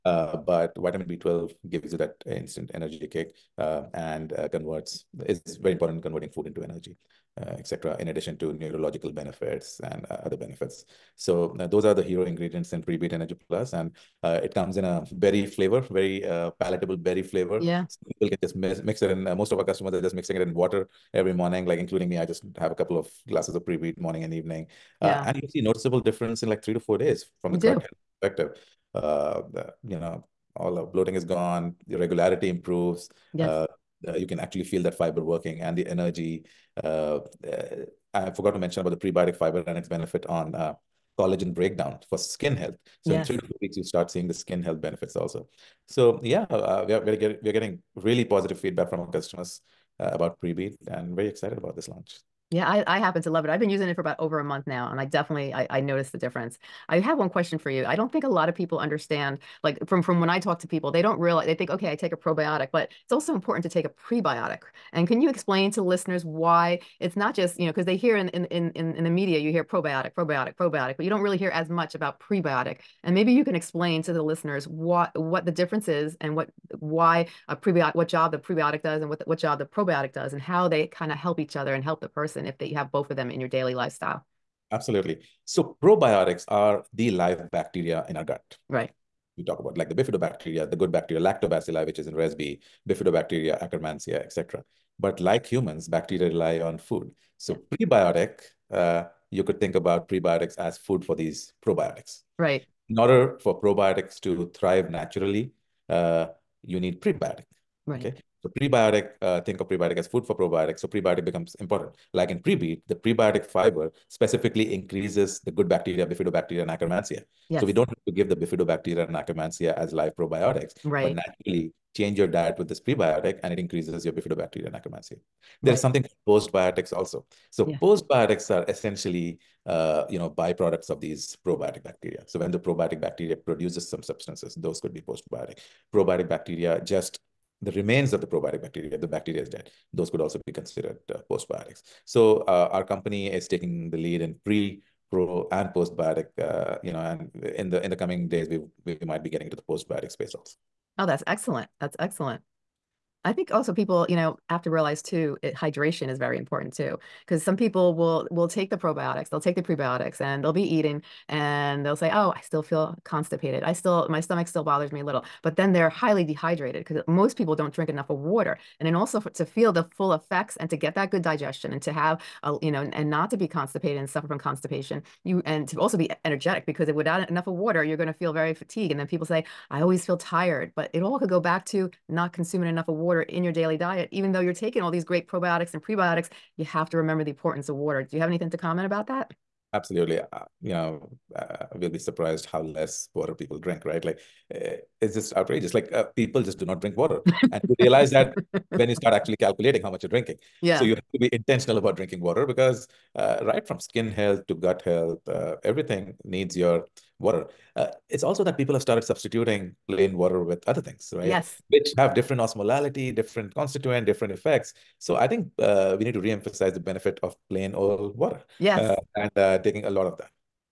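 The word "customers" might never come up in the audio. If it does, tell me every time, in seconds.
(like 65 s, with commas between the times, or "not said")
19 s, 49 s.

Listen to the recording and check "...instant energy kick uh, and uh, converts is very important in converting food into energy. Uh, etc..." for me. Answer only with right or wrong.
right.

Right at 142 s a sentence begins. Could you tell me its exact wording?
So uh, our company is taking the lead in pre, pro, and postbiotic.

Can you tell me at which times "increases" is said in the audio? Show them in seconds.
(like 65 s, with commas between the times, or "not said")
114 s, 123 s.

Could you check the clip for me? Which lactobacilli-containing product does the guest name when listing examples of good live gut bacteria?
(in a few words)
ResB.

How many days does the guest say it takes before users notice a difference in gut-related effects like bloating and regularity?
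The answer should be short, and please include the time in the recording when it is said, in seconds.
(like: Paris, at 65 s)
3 to 4 days, at 26 s.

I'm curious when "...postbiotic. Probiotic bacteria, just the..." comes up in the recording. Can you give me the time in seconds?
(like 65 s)
135 s.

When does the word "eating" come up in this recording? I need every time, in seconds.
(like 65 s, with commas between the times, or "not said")
160 s.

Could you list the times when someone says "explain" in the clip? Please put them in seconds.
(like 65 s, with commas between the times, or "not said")
65 s, 73 s.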